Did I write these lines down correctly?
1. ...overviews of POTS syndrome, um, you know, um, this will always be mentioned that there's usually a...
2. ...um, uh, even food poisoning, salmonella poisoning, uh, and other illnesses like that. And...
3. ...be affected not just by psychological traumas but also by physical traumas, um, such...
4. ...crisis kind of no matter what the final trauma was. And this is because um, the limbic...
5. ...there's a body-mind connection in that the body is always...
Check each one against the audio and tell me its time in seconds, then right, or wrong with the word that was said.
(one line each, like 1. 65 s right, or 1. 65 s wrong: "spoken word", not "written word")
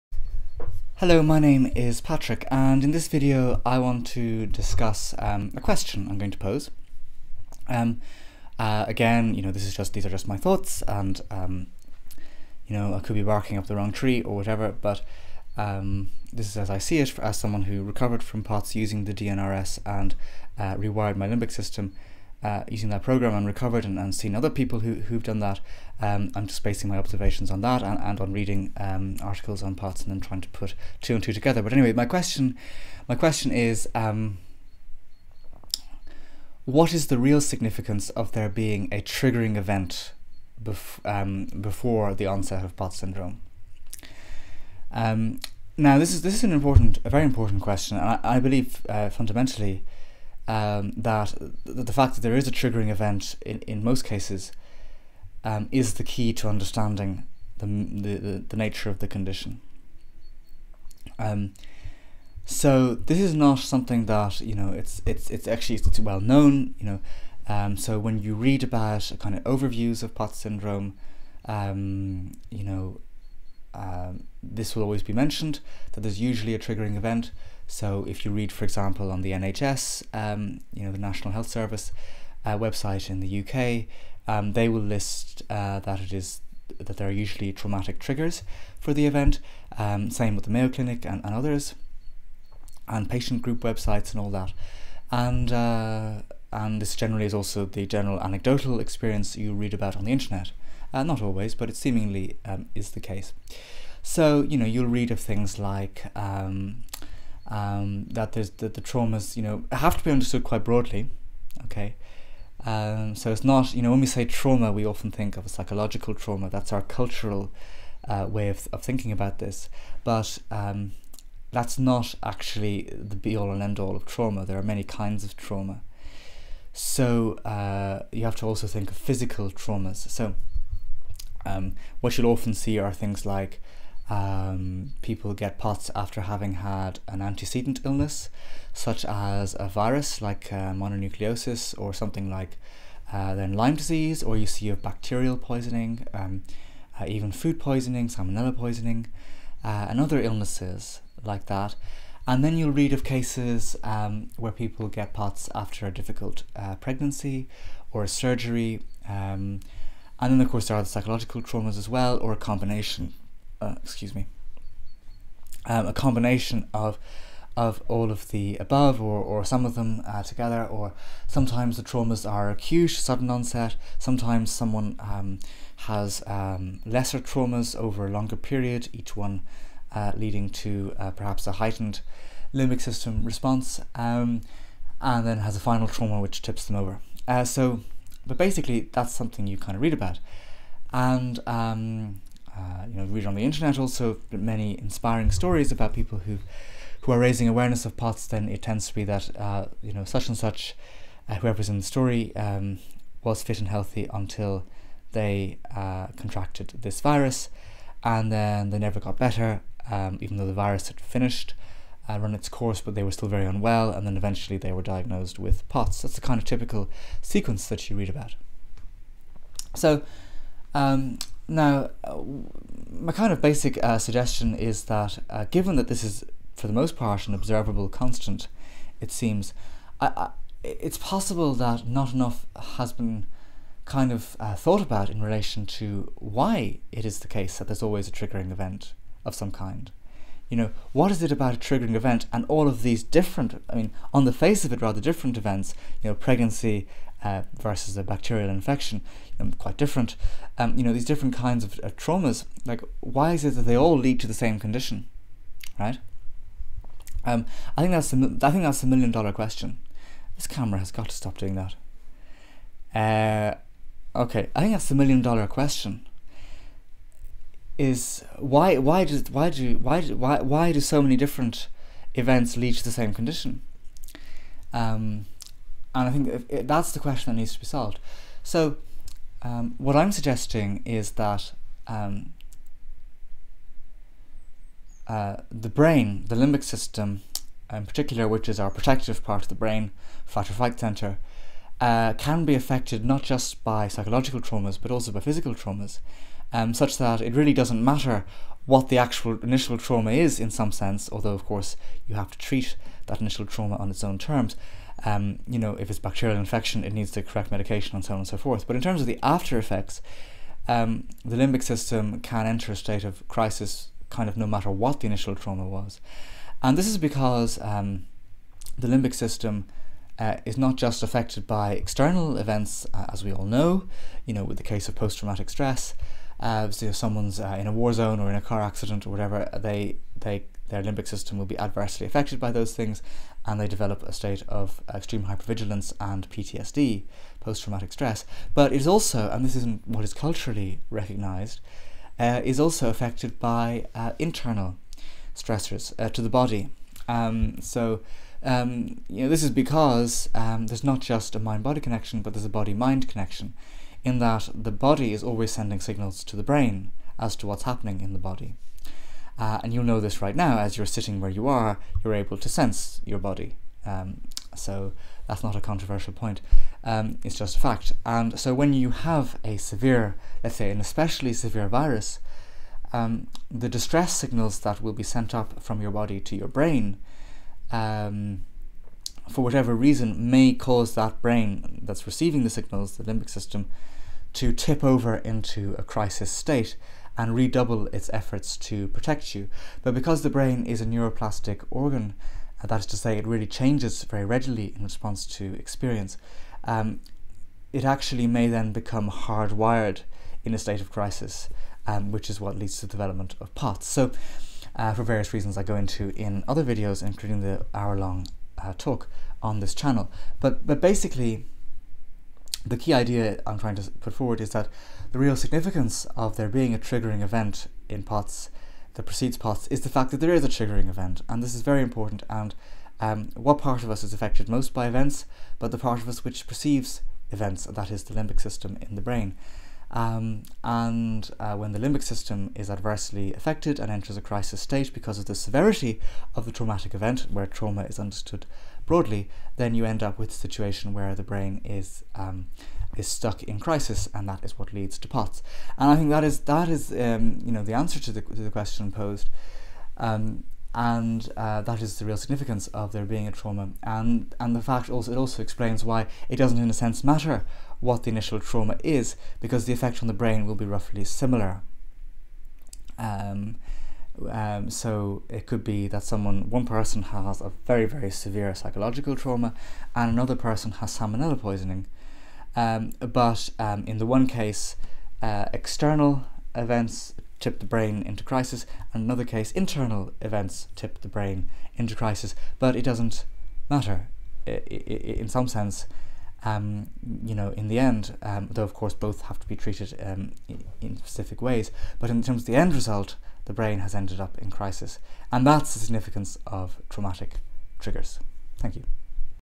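1. 69 s right
2. 146 s right
3. 292 s right
4. 313 s wrong: "initial", not "final"
5. 352 s right.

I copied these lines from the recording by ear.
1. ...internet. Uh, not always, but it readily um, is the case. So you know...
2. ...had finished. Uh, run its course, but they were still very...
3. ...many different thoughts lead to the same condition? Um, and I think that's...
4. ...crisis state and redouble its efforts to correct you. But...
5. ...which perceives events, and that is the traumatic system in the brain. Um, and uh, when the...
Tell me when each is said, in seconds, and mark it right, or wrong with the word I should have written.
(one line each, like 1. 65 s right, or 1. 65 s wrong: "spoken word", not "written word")
1. 100 s wrong: "seemingly", not "readily"
2. 210 s right
3. 271 s wrong: "events", not "thoughts"
4. 385 s wrong: "protect", not "correct"
5. 426 s wrong: "limbic", not "traumatic".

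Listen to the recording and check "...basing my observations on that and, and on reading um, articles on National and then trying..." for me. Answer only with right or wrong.
wrong.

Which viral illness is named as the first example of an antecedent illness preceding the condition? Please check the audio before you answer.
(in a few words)
Mononucleosis.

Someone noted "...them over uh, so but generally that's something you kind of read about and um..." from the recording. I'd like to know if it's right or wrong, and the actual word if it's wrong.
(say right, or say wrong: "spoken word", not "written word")
wrong: "basically", not "generally".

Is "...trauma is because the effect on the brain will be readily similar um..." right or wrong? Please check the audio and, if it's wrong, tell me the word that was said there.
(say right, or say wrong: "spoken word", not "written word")
wrong: "roughly", not "readily".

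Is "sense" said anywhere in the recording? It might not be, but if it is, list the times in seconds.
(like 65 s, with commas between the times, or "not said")
300 s, 362 s, 456 s, 485 s.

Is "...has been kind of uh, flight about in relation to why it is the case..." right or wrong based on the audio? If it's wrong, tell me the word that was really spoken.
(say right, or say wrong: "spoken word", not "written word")
wrong: "thought", not "flight".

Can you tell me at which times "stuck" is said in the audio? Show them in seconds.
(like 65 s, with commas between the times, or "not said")
443 s.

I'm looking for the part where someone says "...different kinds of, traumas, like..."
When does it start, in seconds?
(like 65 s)
251 s.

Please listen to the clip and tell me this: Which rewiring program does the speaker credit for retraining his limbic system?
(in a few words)
DNRS.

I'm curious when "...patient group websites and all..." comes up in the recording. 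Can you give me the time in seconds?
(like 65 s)
93 s.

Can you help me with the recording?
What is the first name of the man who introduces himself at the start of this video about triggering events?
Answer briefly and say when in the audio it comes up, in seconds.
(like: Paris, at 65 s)
Patrick, at 1 s.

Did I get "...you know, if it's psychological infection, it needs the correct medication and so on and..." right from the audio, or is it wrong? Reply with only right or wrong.
wrong.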